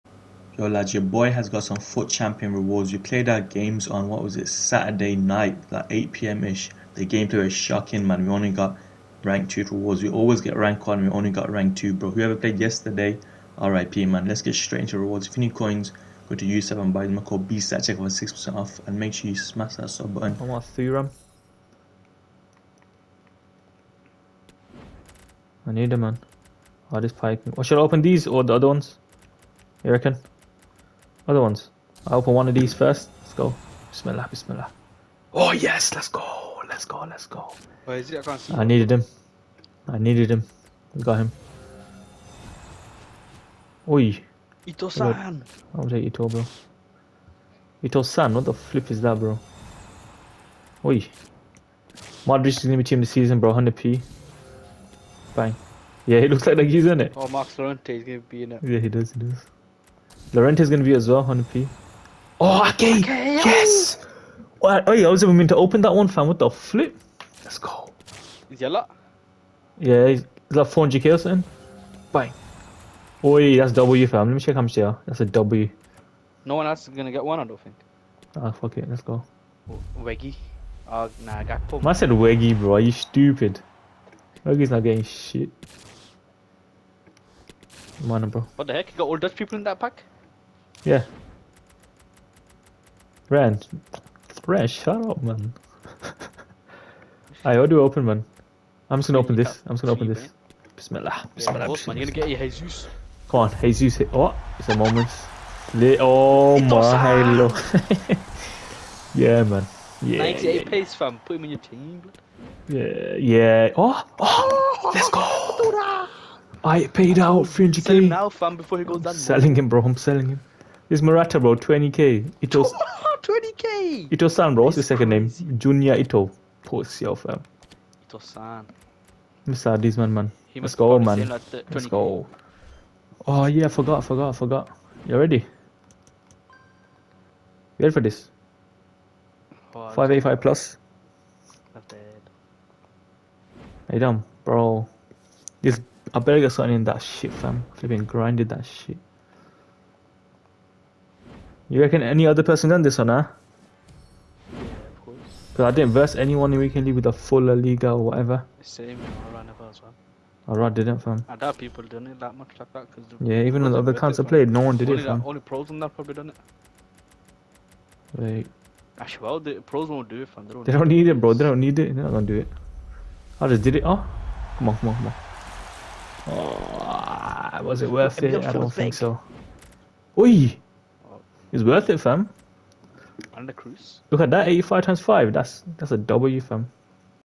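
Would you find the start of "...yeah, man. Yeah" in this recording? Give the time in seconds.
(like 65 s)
109 s.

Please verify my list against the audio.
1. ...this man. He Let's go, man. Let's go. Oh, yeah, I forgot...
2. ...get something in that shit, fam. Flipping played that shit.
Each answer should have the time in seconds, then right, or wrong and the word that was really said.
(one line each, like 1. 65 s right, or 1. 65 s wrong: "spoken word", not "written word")
1. 129 s right
2. 146 s wrong: "grinded", not "played".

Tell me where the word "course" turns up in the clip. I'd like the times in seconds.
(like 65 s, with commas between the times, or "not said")
101 s, 155 s.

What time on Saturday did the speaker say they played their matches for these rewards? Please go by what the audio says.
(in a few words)
8 pm.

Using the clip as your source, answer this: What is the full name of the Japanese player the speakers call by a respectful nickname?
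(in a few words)
Junya Ito.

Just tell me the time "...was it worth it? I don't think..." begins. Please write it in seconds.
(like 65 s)
177 s.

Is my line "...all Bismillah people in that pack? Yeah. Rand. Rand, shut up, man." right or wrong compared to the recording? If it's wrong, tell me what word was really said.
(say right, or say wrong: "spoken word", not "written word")
wrong: "Dutch", not "Bismillah".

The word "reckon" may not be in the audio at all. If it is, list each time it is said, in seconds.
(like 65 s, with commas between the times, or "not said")
29 s, 151 s.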